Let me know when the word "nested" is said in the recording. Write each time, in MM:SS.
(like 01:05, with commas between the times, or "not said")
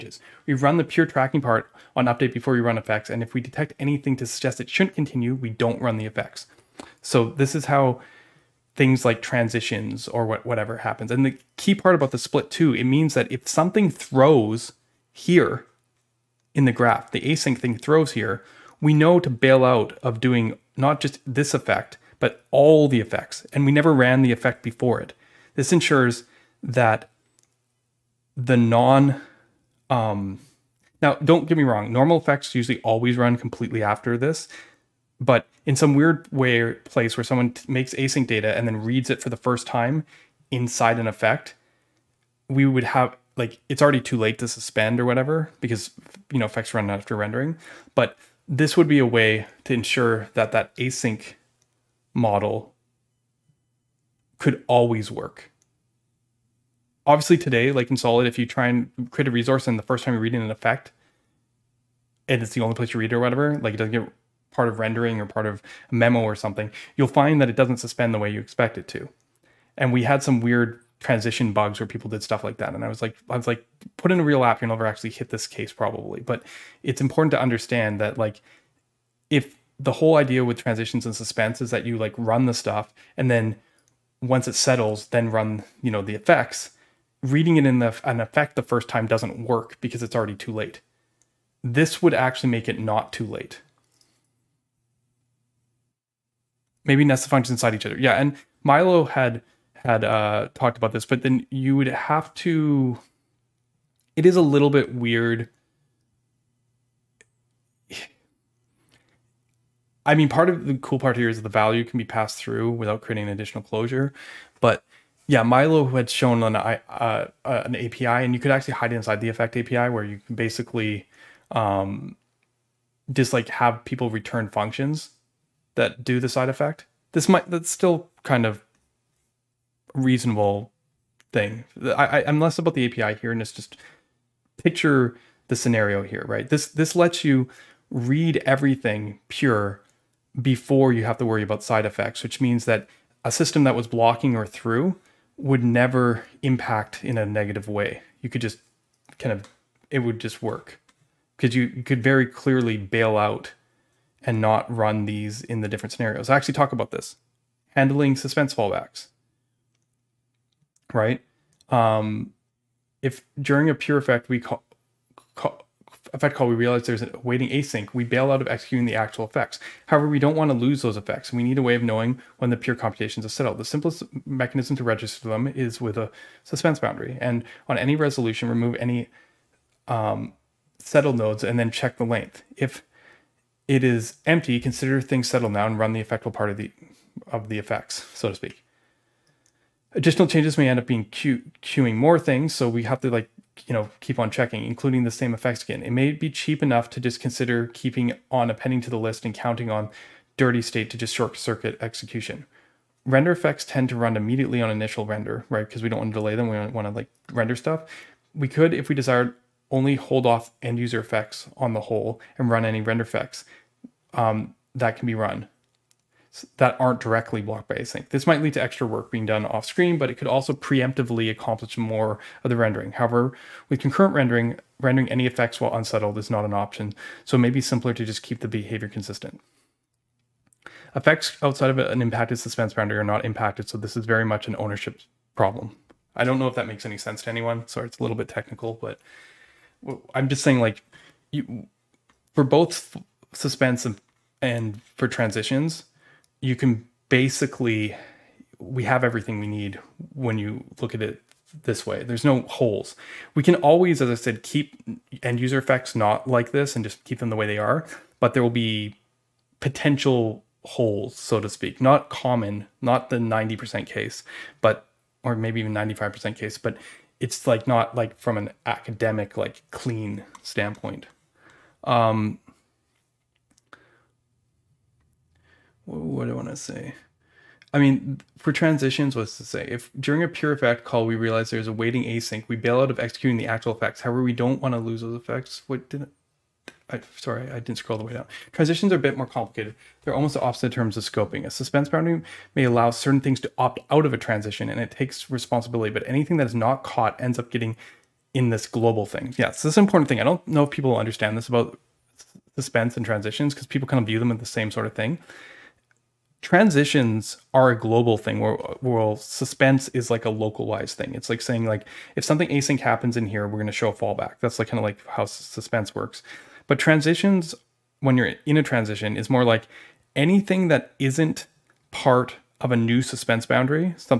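01:37.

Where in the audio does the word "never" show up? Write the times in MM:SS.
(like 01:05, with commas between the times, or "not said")
00:23, 01:14, 02:25.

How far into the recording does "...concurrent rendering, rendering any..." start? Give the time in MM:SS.
03:43.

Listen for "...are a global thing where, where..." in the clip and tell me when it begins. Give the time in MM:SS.
05:07.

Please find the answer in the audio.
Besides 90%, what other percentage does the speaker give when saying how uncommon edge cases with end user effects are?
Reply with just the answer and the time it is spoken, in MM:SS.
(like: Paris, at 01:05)
95%, at 04:25.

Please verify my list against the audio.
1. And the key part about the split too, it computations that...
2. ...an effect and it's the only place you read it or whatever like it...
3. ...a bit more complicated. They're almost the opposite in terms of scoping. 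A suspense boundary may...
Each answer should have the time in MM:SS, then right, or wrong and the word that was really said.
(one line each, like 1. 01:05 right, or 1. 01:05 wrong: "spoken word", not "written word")
1. 00:11 wrong: "means", not "computations"
2. 01:00 right
3. 04:48 right.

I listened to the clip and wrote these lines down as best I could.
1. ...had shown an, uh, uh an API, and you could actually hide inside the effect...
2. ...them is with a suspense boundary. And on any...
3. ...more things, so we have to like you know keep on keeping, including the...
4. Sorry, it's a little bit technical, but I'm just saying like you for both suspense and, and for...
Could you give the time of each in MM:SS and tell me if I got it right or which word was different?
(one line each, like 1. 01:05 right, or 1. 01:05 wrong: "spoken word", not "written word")
1. 01:55 right
2. 02:55 right
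3. 03:11 wrong: "checking", not "keeping"
4. 03:57 right.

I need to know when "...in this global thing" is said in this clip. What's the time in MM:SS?
04:58.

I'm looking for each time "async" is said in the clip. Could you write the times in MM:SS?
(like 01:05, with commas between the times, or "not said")
00:17, 00:37, 00:50, 02:47, 03:37, 04:42, 05:12.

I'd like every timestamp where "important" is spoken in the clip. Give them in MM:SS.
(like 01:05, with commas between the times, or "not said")
01:17, 04:59.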